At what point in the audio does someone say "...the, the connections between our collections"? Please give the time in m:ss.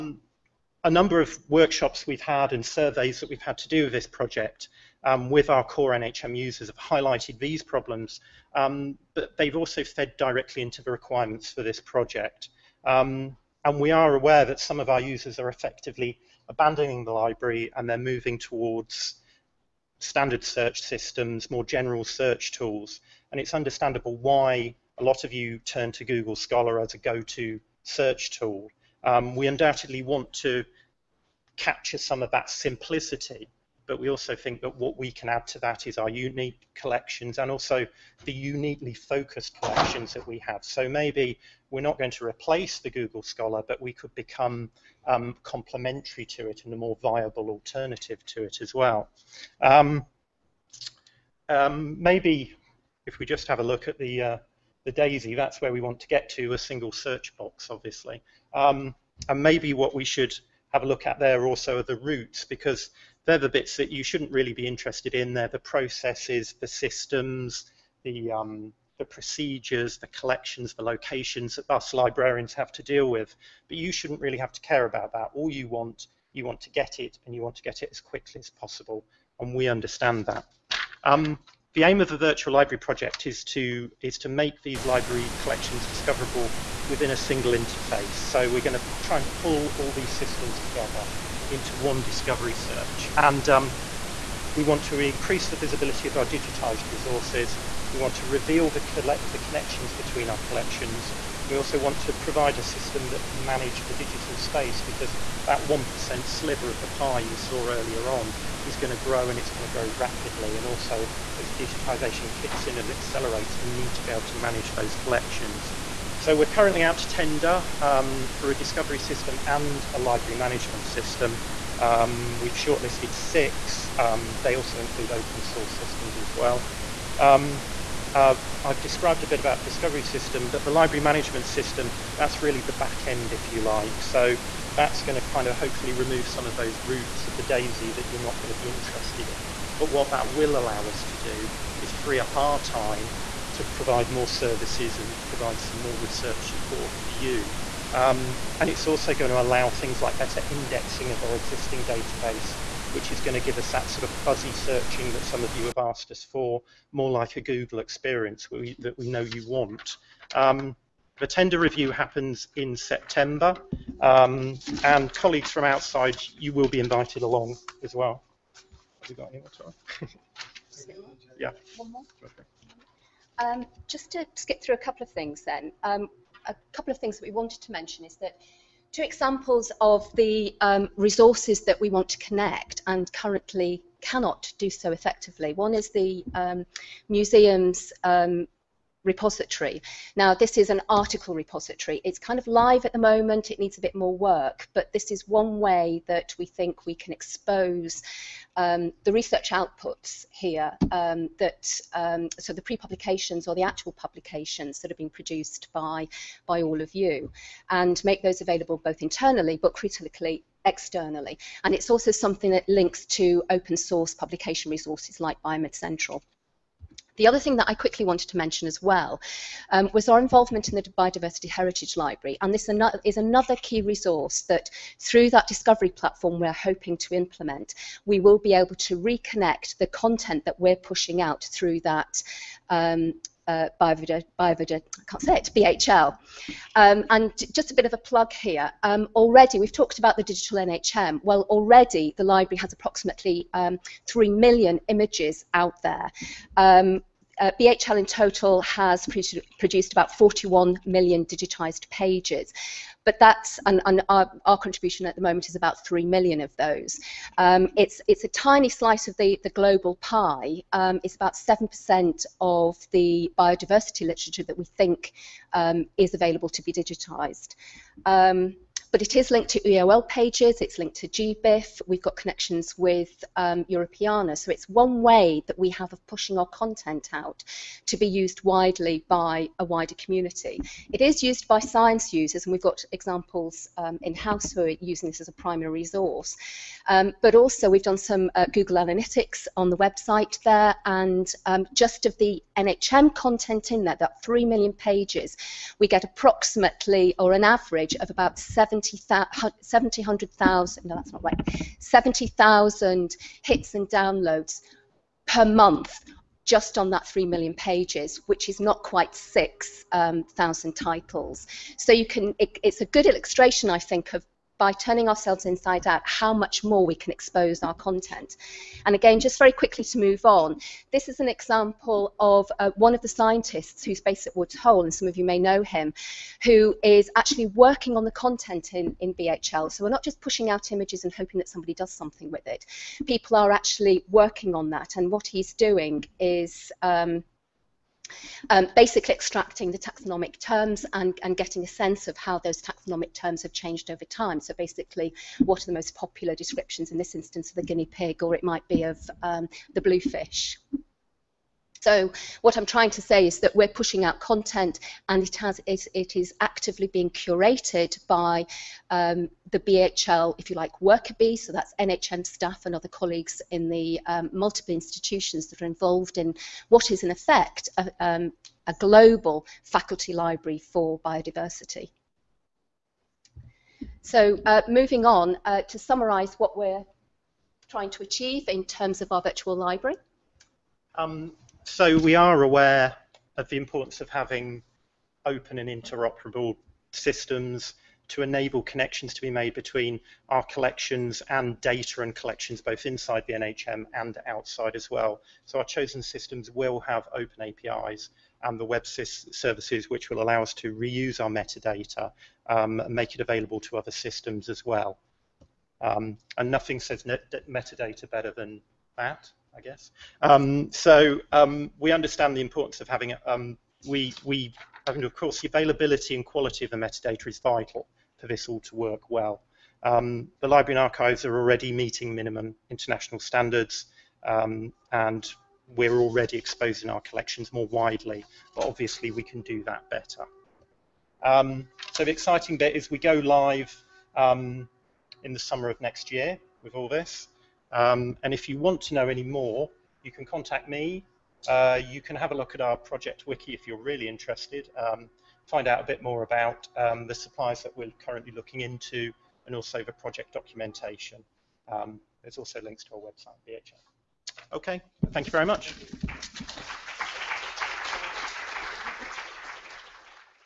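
1:38.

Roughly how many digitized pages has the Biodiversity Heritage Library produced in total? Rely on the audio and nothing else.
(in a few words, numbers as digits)
41 million.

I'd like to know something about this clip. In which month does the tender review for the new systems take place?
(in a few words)
September.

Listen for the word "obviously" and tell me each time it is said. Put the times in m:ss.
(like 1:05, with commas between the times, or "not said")
0:57, 7:08.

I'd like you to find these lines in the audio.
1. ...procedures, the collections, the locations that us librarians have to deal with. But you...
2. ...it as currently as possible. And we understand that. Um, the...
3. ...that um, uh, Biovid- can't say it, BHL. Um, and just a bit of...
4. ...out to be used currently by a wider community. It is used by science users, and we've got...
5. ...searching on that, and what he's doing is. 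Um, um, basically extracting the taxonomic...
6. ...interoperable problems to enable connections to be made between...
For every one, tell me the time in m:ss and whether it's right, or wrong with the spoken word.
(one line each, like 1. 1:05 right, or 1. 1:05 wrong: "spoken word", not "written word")
1. 1:09 right
2. 1:17 wrong: "quickly", not "currently"
3. 3:51 right
4. 4:37 wrong: "widely", not "currently"
5. 5:34 wrong: "working", not "searching"
6. 6:25 wrong: "systems", not "problems".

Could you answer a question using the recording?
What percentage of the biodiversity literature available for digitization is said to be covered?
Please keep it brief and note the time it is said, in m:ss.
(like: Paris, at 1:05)
7%, at 4:21.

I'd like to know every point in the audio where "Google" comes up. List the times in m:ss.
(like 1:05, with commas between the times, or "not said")
0:26, 0:42, 2:37, 4:48.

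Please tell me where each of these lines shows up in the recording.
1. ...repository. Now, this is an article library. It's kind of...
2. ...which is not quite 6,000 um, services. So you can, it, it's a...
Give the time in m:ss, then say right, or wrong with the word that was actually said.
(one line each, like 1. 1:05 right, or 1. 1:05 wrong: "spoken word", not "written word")
1. 3:09 wrong: "repository", not "library"
2. 5:08 wrong: "titles", not "services".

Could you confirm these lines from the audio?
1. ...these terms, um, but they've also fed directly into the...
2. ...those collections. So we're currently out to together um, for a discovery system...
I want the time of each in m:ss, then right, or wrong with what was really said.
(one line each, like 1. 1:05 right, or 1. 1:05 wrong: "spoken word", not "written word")
1. 0:07 wrong: "problems", not "terms"
2. 1:54 wrong: "tender", not "together".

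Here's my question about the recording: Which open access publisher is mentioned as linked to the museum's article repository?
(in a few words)
Biomed Central.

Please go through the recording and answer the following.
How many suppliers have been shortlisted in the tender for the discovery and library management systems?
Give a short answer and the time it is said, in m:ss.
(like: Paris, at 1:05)
6, at 2:03.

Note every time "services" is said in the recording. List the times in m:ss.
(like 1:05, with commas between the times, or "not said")
2:24, 6:38.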